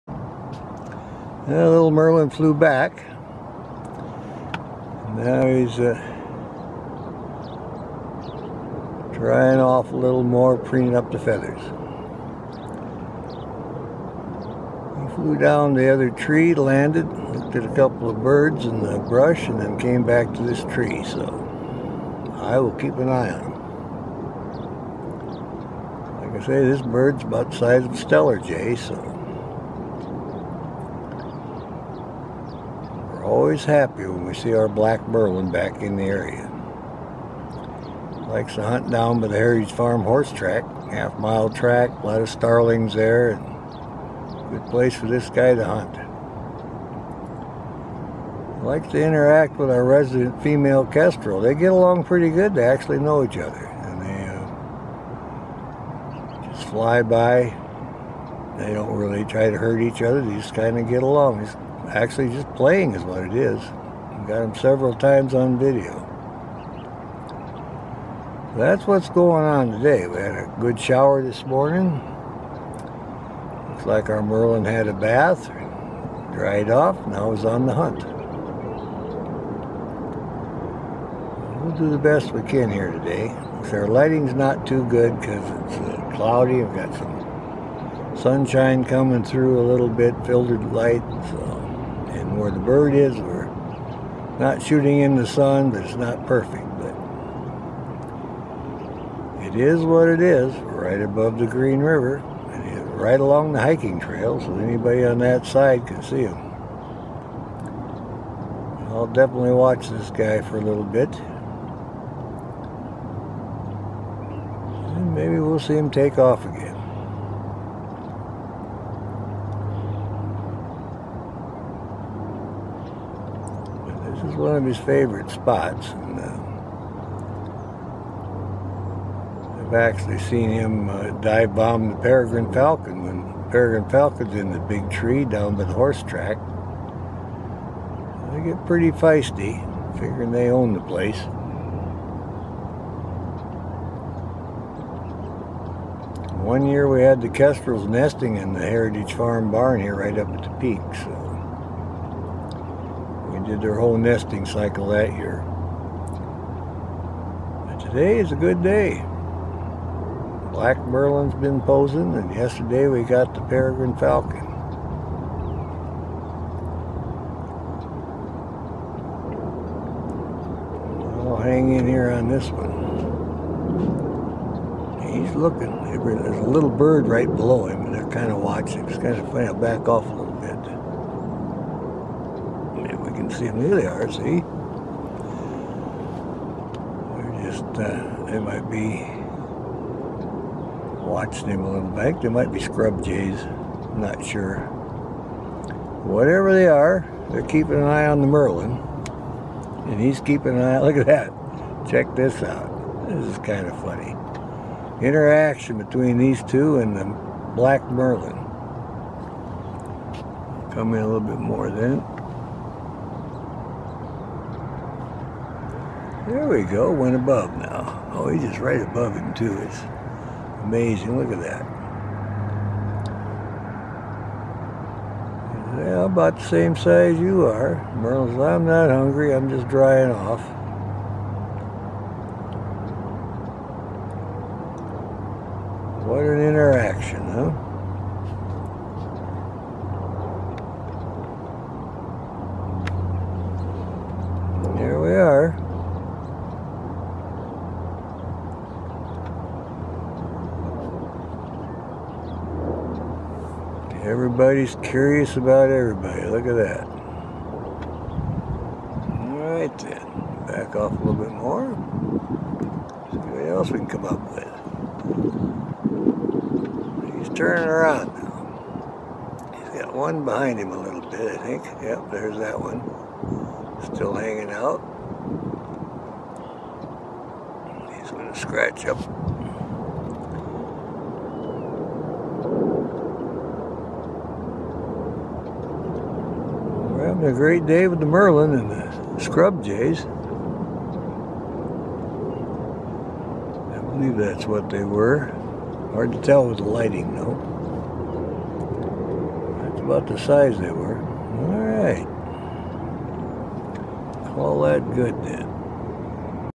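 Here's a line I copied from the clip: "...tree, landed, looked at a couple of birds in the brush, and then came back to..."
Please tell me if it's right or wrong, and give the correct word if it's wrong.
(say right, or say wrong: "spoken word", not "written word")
right.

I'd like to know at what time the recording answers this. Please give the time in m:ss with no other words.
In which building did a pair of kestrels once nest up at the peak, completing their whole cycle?
2:28.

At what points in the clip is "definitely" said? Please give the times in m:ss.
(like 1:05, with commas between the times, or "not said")
1:49.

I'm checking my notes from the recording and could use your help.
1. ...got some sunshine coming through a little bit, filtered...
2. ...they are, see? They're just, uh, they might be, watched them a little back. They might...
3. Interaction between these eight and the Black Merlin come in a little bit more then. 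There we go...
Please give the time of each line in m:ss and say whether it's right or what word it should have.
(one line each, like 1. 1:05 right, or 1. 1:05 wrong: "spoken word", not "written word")
1. 1:26 right
2. 3:03 right
3. 3:25 wrong: "two", not "eight".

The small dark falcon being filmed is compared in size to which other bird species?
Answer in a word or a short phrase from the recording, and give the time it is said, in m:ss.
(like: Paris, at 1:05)
Steller jay, at 0:27.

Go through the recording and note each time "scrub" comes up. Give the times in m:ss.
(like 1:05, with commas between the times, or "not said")
3:12, 4:49.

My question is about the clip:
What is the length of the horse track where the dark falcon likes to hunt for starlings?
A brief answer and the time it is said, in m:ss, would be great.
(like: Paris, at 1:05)
half mile, at 0:40.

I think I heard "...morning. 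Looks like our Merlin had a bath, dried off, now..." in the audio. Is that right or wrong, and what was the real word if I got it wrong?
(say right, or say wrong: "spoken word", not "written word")
right.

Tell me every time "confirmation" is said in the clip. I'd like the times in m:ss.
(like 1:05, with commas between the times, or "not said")
not said.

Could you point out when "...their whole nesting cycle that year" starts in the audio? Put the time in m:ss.
2:33.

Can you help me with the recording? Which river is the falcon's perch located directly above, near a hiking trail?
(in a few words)
Green River.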